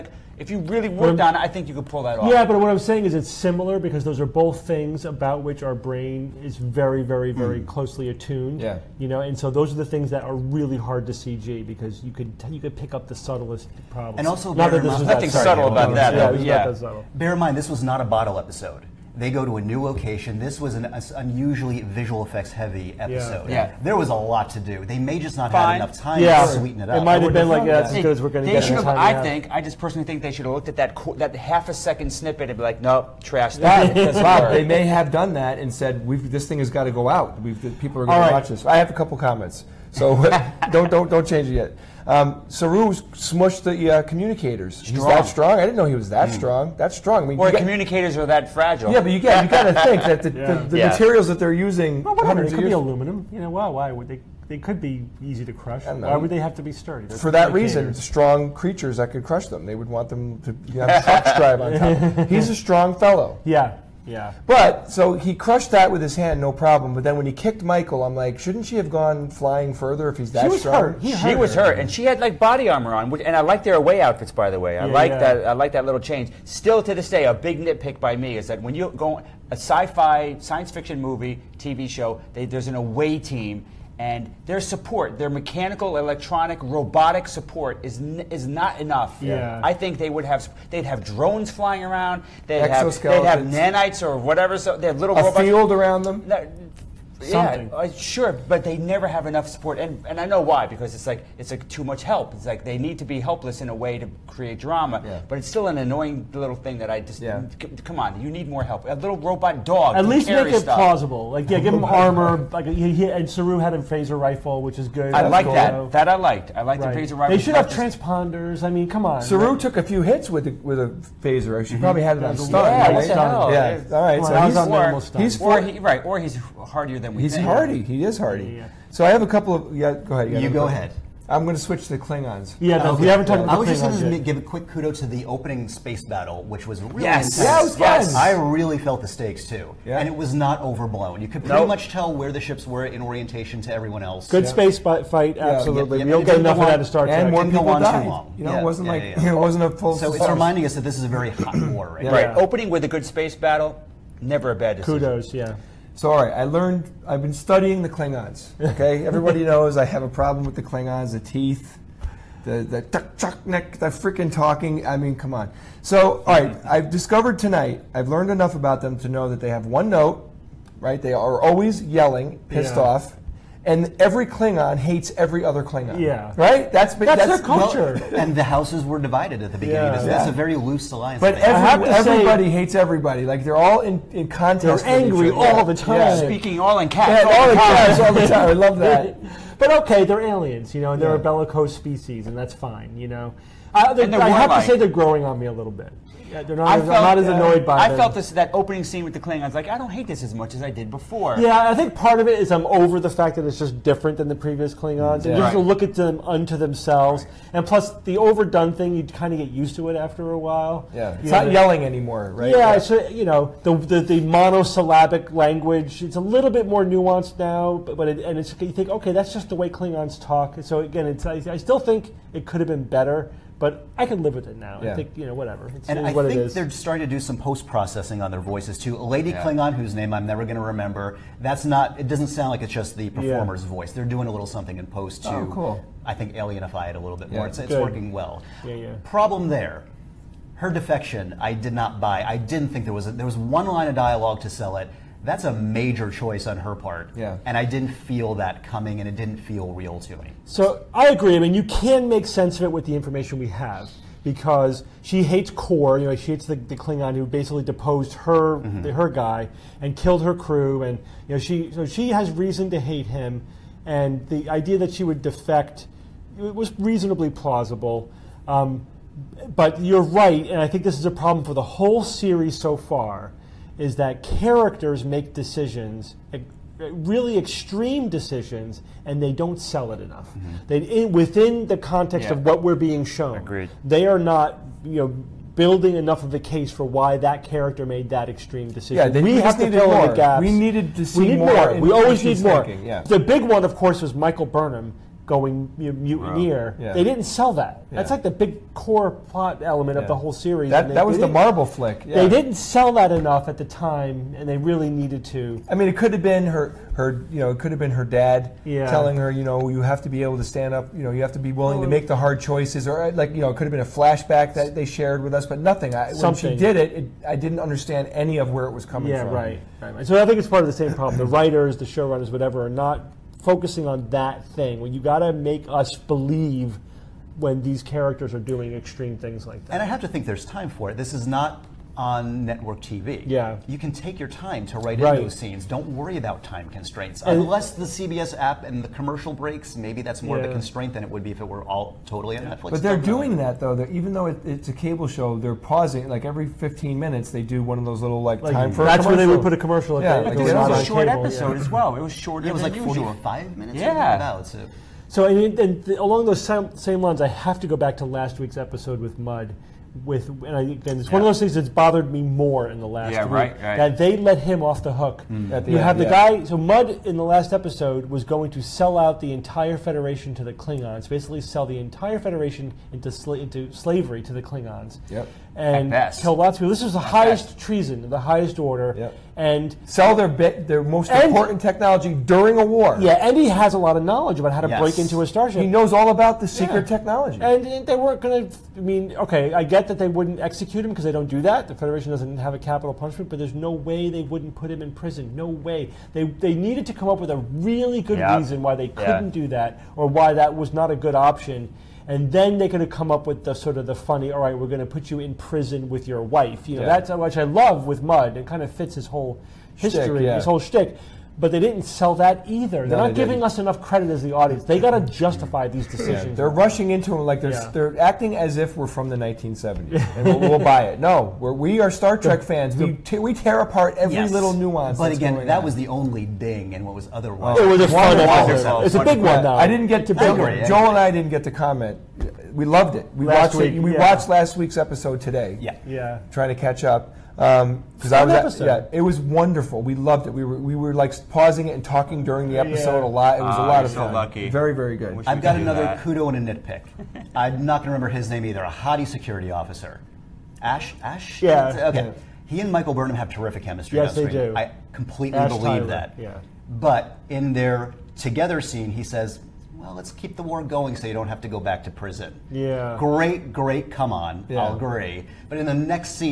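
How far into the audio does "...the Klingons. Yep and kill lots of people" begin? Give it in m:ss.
6:14.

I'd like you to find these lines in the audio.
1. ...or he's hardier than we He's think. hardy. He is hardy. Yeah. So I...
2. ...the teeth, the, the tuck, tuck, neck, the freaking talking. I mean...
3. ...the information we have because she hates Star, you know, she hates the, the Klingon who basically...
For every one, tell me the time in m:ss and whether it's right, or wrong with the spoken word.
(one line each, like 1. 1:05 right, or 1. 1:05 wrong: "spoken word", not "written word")
1. 2:06 right
2. 2:41 right
3. 4:12 wrong: "Kol", not "Star".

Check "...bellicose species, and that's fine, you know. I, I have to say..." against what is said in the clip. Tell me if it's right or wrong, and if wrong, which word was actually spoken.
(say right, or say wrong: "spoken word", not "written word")
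right.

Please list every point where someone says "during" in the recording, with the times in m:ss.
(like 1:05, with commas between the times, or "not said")
6:22, 7:22.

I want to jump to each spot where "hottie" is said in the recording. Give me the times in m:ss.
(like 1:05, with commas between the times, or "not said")
7:28.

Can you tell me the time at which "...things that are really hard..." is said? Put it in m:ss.
0:09.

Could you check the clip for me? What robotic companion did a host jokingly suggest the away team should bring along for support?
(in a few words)
A little robot dog.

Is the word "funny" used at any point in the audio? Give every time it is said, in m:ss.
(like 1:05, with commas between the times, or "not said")
6:43.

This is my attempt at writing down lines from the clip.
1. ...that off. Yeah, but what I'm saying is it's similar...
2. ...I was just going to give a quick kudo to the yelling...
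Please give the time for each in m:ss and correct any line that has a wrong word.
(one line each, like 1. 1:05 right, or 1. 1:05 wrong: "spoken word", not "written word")
1. 0:02 right
2. 2:13 wrong: "opening", not "yelling".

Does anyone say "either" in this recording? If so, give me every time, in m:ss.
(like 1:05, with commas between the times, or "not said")
6:52, 7:28.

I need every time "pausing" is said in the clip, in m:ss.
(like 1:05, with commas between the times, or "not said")
5:45, 7:21.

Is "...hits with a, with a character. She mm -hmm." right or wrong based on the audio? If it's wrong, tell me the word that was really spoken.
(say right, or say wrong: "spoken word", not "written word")
wrong: "phaser", not "character".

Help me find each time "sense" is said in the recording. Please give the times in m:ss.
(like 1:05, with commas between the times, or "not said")
4:12.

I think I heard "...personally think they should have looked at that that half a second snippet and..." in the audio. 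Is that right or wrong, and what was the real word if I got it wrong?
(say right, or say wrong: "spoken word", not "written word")
right.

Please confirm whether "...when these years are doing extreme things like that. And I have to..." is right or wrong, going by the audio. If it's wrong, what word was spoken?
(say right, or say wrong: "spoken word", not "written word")
wrong: "characters", not "years".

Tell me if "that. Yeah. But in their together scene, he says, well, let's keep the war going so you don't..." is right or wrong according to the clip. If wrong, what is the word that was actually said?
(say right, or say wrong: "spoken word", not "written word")
right.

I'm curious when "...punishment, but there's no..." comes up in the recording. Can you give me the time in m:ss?
6:32.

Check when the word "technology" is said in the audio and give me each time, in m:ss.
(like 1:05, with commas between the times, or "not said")
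6:21, 6:26.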